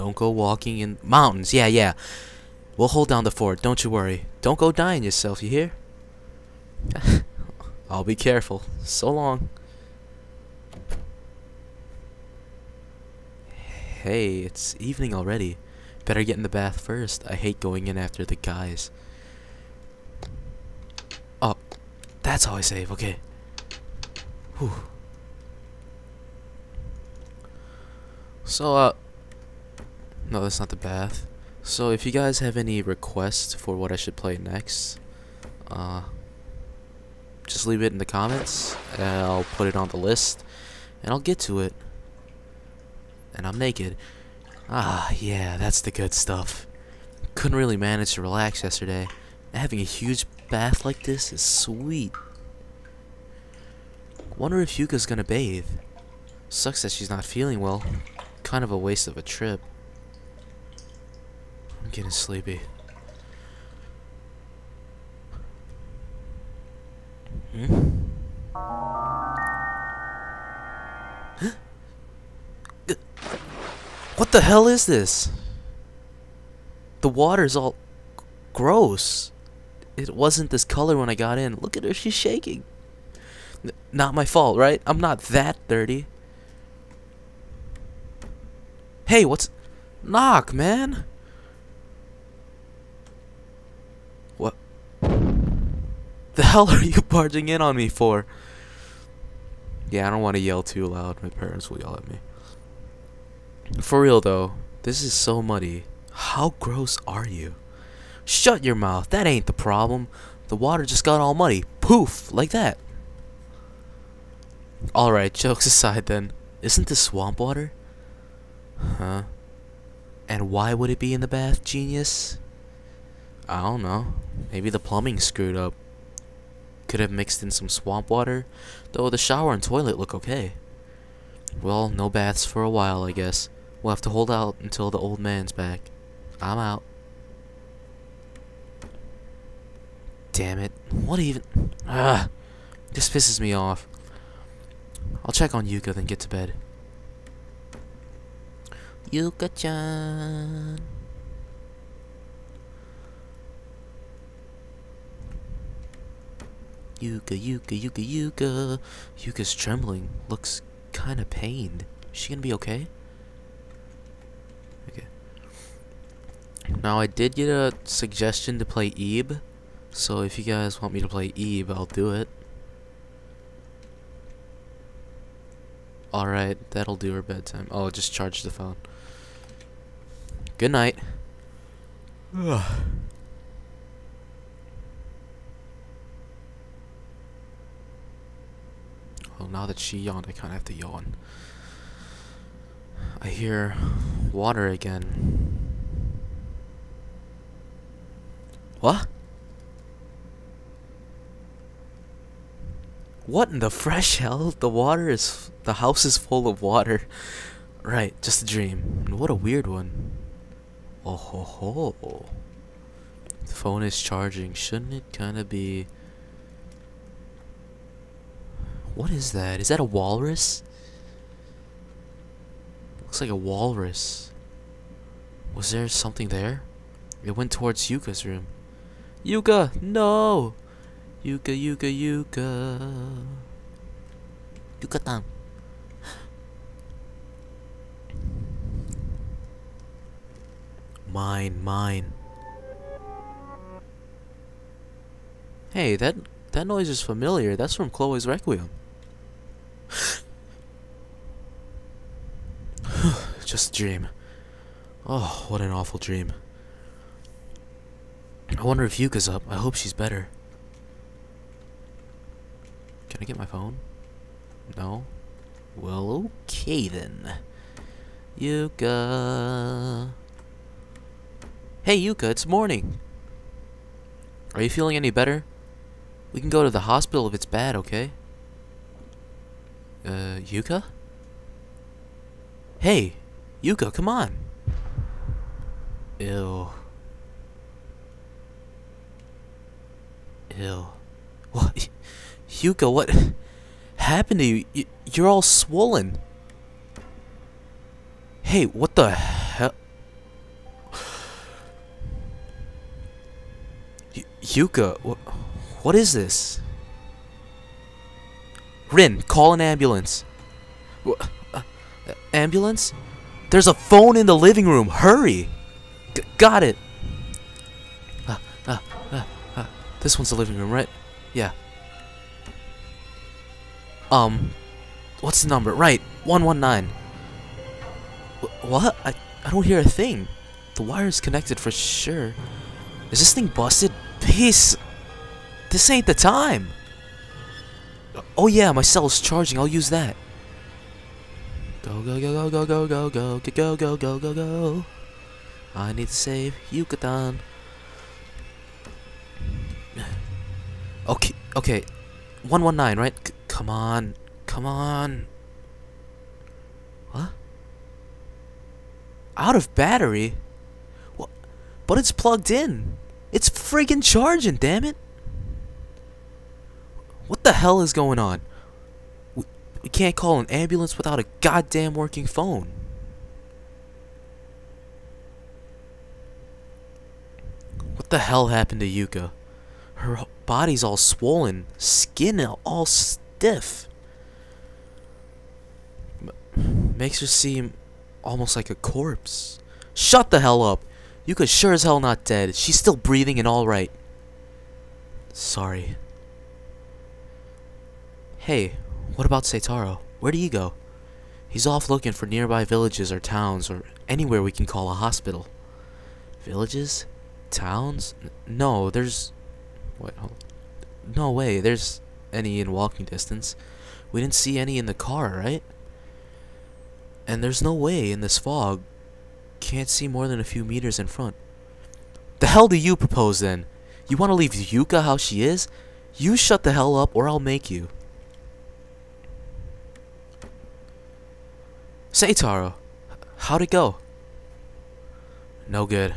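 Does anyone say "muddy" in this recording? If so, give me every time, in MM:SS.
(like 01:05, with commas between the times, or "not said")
01:45, 01:51.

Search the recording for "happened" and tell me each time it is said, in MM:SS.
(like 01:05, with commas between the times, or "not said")
04:53, 06:18.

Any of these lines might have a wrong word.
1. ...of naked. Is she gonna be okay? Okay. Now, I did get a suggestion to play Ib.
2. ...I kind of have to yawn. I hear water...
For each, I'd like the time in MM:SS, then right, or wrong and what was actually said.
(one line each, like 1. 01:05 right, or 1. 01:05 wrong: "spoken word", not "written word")
1. 02:41 wrong: "pained", not "naked"
2. 03:10 right.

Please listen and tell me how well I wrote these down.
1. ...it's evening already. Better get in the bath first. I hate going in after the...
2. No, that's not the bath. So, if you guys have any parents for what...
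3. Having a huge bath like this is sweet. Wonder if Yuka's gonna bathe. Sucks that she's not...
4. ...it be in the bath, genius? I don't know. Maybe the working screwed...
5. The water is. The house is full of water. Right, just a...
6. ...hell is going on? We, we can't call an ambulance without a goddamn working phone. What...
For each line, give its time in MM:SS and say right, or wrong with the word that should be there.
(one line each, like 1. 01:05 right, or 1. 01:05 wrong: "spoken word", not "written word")
1. 00:14 right
2. 00:30 wrong: "requests", not "parents"
3. 00:49 right
4. 02:00 wrong: "plumbing", not "working"
5. 03:24 right
6. 06:07 right.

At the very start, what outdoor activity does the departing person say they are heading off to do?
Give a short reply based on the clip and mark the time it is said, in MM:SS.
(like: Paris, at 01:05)
Walking in mountains, at 00:00.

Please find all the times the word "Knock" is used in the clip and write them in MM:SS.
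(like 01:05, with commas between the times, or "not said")
01:30.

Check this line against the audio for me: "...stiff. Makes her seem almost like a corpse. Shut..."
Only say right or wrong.
right.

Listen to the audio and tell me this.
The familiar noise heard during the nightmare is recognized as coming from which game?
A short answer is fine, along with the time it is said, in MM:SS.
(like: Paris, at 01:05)
Chloe's Requiem, at 04:07.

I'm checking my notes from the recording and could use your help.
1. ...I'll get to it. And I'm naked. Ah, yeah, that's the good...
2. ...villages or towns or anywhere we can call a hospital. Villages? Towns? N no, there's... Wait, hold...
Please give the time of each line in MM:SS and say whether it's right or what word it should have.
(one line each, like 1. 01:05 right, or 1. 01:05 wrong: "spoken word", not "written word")
1. 00:41 right
2. 06:42 right.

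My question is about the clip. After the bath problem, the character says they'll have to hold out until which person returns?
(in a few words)
The old man.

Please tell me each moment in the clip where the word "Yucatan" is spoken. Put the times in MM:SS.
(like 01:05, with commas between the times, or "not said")
03:54, 05:46.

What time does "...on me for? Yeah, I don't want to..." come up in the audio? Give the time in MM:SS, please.
01:37.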